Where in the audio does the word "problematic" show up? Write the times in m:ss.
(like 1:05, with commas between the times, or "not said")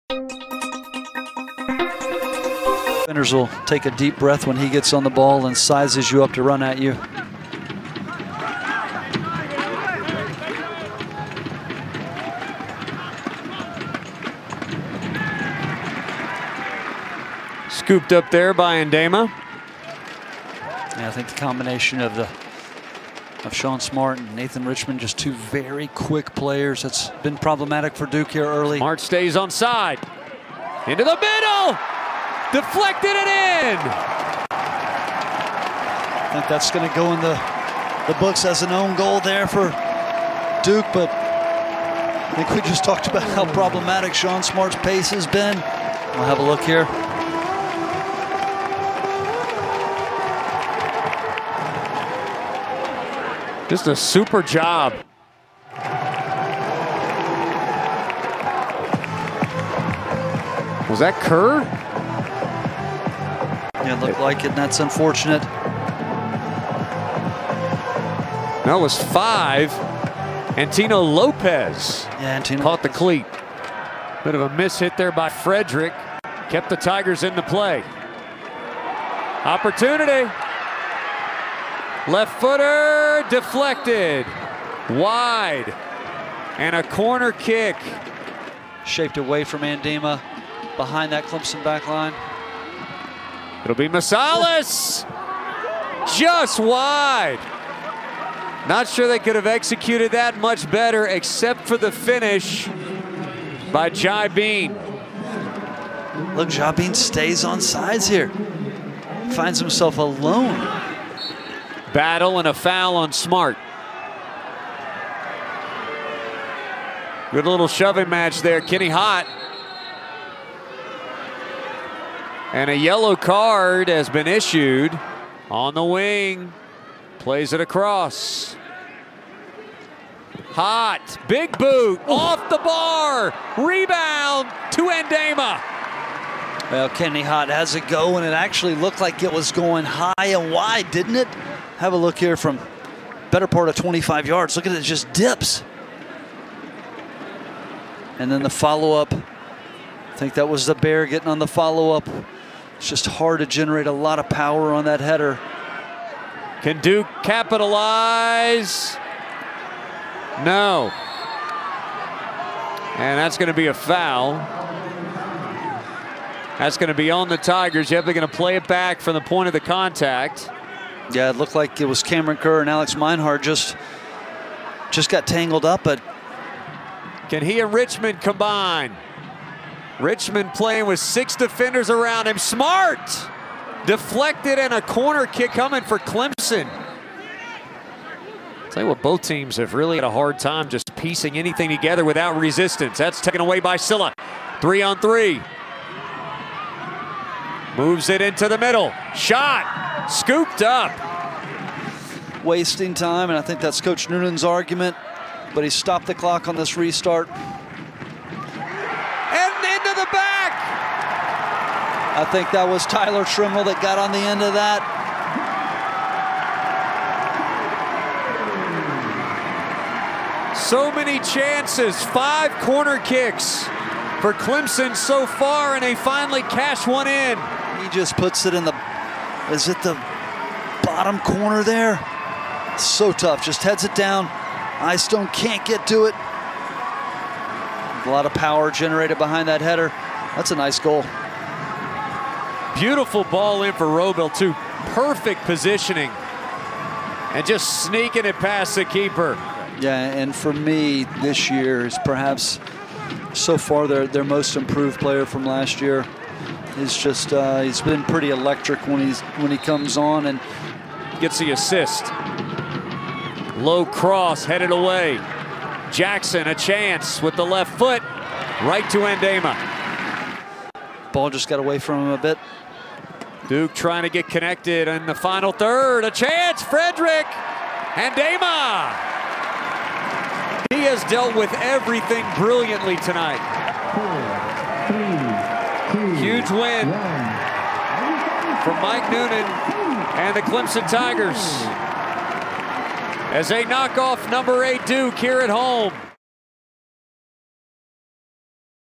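0:27, 0:43.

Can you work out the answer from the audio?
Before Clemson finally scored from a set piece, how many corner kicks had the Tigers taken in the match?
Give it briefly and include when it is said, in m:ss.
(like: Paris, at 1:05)
5, at 3:42.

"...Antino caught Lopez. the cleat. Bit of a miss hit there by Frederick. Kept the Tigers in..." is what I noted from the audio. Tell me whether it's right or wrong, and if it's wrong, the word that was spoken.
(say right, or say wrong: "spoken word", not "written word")
right.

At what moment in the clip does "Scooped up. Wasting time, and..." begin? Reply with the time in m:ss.
3:20.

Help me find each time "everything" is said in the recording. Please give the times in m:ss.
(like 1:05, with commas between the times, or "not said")
4:41.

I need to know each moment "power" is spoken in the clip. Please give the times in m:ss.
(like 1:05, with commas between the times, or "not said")
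2:34, 3:58.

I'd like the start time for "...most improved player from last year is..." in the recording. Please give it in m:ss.
4:14.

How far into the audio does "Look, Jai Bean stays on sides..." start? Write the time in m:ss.
1:46.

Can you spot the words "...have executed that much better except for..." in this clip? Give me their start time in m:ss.
1:39.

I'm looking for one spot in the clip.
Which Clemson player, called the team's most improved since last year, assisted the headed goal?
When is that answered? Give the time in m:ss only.
4:03.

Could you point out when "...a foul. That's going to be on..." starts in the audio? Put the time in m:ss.
2:43.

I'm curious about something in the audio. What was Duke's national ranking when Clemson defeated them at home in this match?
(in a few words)
8.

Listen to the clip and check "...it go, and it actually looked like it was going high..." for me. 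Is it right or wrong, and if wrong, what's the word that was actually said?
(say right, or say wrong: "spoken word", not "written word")
right.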